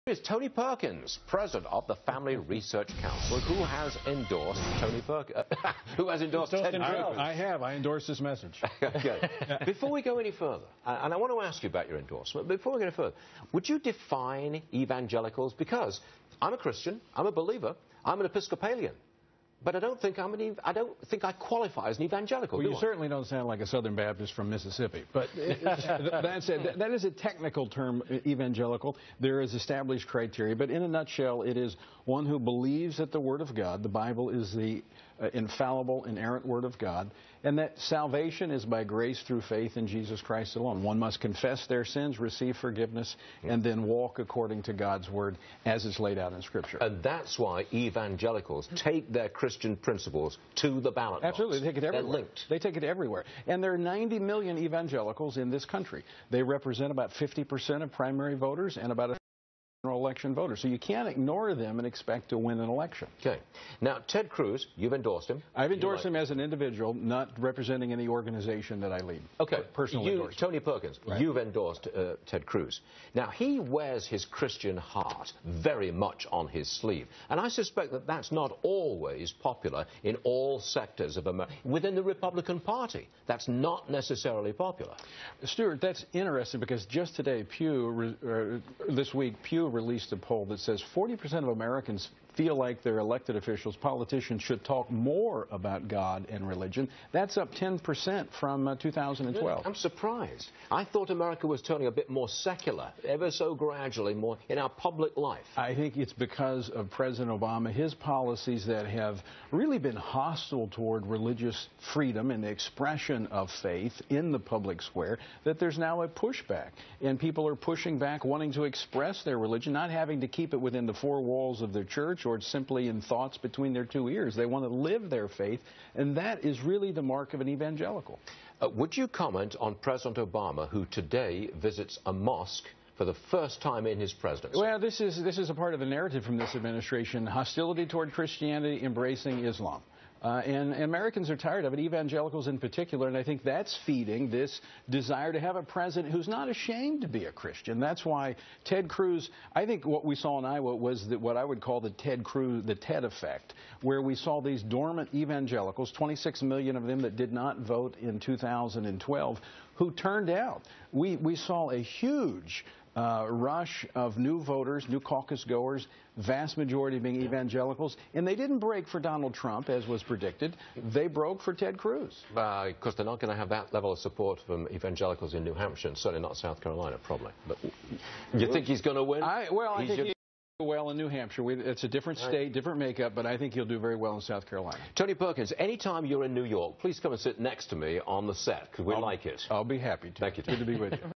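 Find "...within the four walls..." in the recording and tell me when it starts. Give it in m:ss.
2:00.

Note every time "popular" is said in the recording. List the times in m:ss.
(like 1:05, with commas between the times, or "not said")
1:19, 1:24.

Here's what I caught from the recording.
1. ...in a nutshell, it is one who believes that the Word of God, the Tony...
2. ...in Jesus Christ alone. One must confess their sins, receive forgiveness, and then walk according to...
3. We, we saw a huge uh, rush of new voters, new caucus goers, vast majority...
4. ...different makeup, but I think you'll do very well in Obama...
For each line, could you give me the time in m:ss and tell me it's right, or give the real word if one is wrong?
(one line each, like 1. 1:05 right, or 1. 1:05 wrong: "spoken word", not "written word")
1. 0:30 wrong: "Bible", not "Tony"
2. 0:39 right
3. 2:40 right
4. 3:02 wrong: "South", not "Obama".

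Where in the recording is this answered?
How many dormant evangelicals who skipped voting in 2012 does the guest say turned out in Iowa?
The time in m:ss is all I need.
2:35.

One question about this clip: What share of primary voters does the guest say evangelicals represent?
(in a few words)
50%.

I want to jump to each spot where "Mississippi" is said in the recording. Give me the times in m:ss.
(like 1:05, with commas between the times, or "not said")
0:24.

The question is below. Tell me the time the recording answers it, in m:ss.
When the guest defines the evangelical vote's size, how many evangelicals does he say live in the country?
0:53.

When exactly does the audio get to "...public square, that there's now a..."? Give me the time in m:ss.
1:54.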